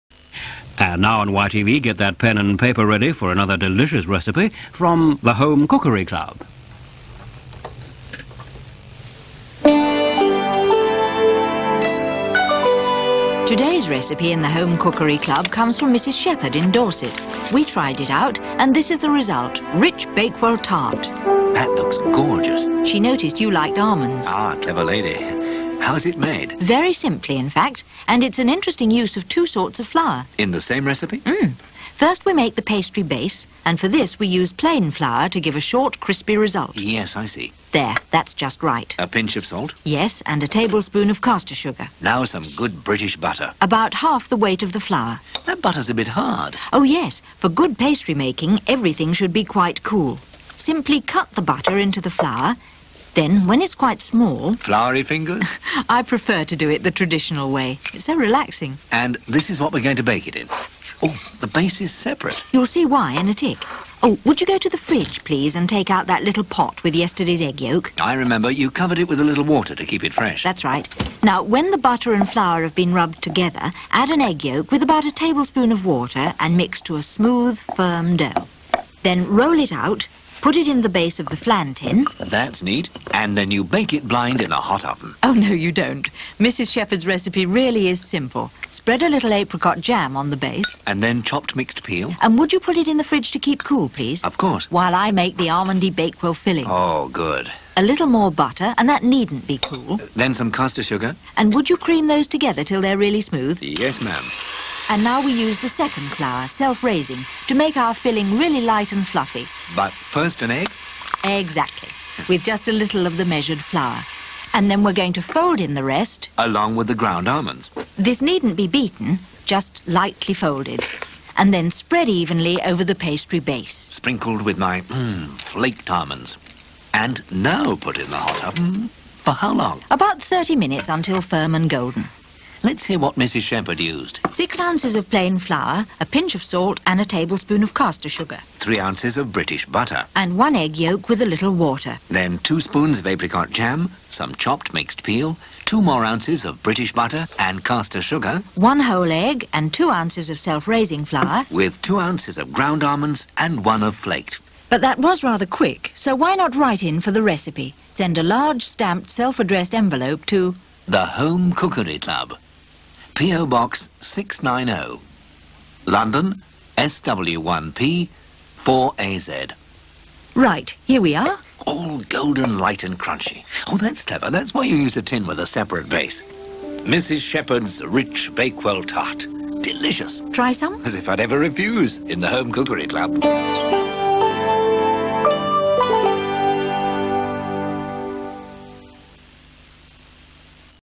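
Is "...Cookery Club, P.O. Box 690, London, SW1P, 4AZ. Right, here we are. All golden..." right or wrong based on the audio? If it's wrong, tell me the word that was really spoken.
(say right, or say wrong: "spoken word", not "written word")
right.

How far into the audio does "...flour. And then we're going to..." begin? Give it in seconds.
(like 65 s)
113 s.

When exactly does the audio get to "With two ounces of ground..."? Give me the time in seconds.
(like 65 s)
151 s.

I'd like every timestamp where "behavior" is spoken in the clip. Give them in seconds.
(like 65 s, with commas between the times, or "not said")
not said.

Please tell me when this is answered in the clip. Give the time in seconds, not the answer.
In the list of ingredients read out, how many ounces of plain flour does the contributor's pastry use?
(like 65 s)
134 s.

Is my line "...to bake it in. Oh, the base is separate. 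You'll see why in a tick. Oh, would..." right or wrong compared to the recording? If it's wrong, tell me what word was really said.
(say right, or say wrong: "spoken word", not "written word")
right.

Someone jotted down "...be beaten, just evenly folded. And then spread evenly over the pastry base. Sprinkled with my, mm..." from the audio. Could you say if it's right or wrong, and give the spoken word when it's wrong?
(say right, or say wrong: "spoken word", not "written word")
wrong: "lightly", not "evenly".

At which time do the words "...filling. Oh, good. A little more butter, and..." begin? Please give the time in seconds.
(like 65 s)
96 s.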